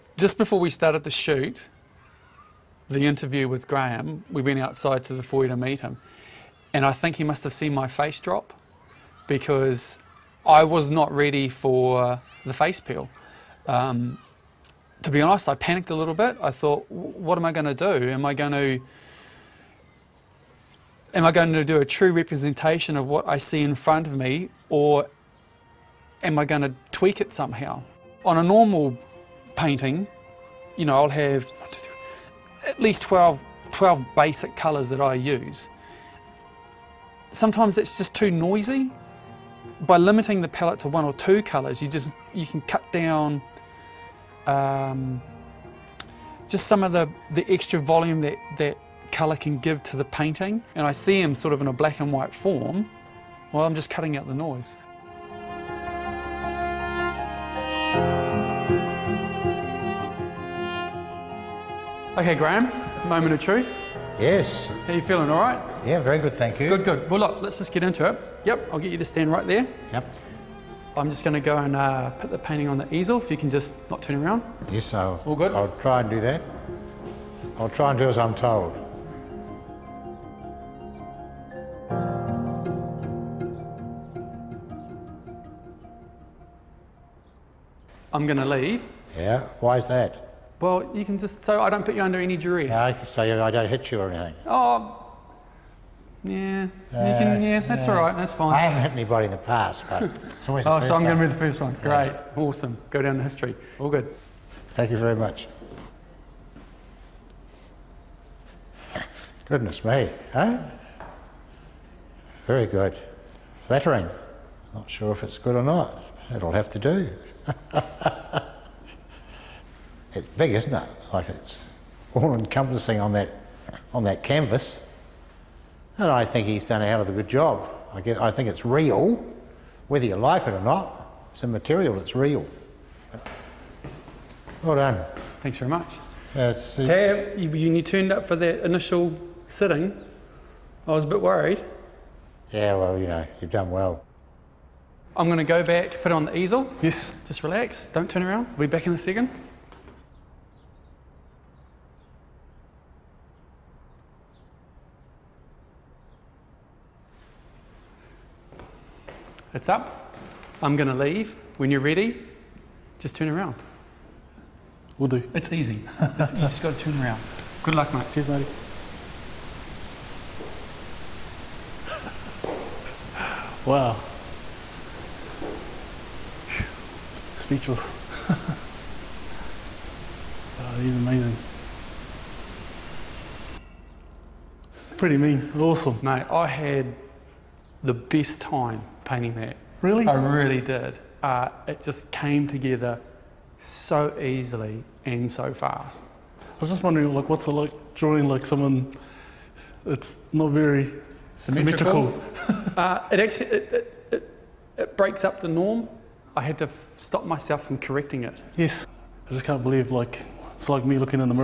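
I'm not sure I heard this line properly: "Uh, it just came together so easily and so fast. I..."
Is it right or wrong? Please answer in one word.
right.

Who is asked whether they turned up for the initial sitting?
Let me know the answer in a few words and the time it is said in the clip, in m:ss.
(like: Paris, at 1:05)
Taya, at 2:16.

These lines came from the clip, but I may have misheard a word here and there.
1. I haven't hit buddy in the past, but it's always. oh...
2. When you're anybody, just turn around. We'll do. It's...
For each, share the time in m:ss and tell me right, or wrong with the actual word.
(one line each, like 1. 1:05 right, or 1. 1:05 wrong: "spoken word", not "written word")
1. 1:38 wrong: "anybody", not "buddy"
2. 2:41 wrong: "ready", not "anybody".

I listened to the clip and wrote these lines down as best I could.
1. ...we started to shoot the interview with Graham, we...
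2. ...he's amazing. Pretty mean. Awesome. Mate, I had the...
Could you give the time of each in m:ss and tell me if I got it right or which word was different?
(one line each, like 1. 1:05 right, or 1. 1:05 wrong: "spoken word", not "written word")
1. 0:00 right
2. 3:00 right.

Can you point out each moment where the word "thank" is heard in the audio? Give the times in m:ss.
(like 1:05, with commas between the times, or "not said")
1:06, 1:44, 2:15.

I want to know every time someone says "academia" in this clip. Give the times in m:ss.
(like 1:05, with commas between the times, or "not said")
not said.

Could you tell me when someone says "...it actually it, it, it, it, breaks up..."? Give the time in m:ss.
3:23.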